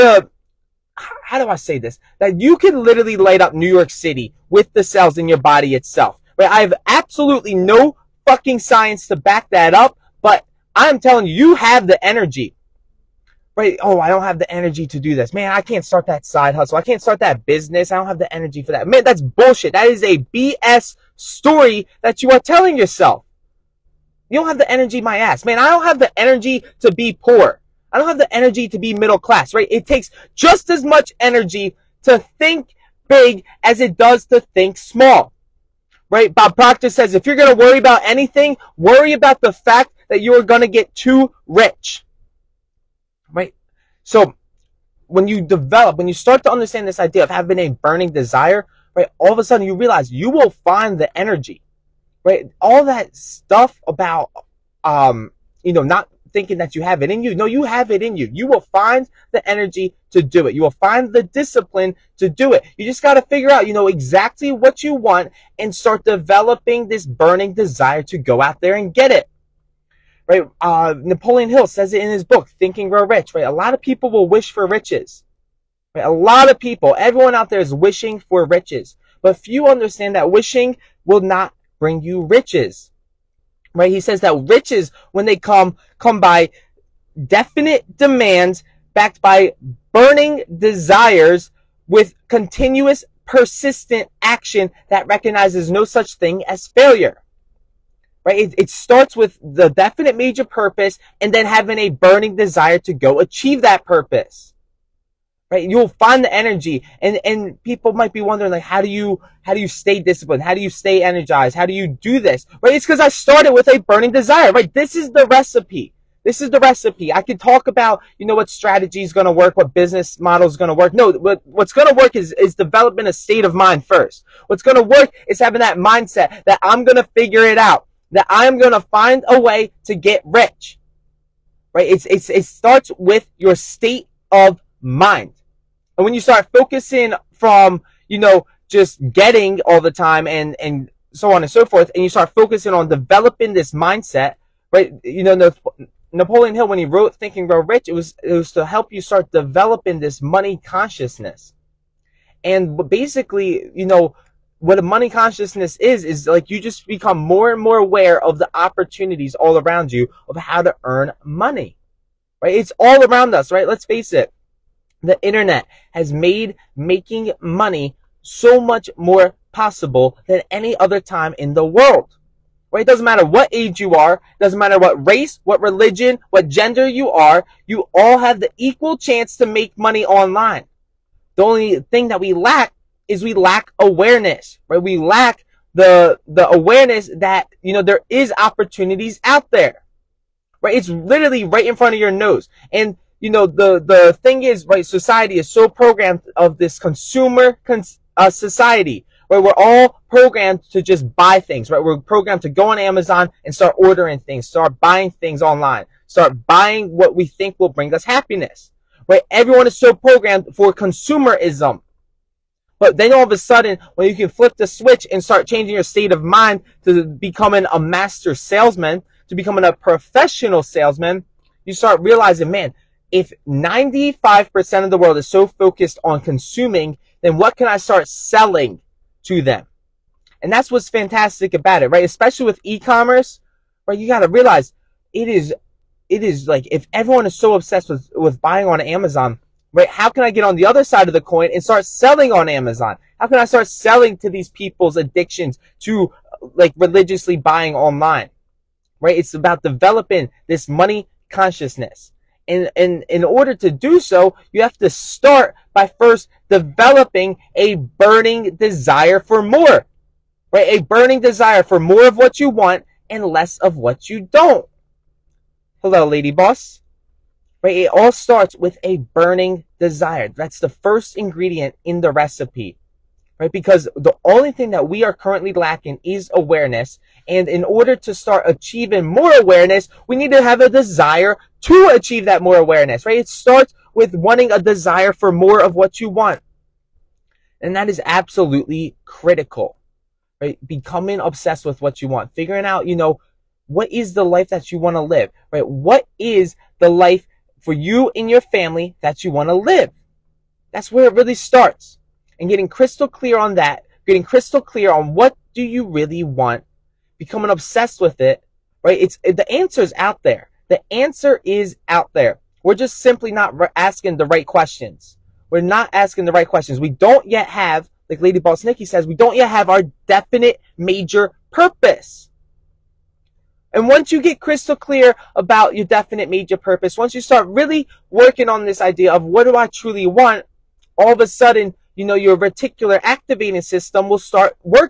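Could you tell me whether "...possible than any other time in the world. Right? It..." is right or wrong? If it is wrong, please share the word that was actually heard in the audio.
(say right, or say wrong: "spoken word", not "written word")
right.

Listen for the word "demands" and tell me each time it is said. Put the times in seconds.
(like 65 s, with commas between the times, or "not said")
87 s.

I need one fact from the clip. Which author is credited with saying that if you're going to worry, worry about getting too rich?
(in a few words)
Bob Proctor.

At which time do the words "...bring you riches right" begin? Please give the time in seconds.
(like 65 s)
81 s.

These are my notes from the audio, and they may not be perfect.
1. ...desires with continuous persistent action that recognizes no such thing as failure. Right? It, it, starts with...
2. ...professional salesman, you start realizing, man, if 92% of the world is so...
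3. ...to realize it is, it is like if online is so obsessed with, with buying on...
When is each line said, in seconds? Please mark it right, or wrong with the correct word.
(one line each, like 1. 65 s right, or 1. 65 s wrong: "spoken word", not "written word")
1. 90 s right
2. 219 s wrong: "95", not "92"
3. 234 s wrong: "everyone", not "online".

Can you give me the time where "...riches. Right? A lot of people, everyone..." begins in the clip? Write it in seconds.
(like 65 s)
74 s.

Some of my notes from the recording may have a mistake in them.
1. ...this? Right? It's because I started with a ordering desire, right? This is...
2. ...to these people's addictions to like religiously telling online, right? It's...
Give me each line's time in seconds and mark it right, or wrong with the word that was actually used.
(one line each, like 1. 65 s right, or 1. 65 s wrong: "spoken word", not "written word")
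1. 112 s wrong: "burning", not "ordering"
2. 244 s wrong: "buying", not "telling".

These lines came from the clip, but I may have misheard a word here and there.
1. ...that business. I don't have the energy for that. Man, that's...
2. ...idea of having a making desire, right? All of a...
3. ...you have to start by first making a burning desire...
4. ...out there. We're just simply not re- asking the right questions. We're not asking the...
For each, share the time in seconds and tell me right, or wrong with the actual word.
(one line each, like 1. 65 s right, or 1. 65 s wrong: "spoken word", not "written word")
1. 17 s right
2. 46 s wrong: "burning", not "making"
3. 254 s wrong: "developing", not "making"
4. 311 s right.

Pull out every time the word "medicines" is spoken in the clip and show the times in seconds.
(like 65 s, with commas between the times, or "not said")
not said.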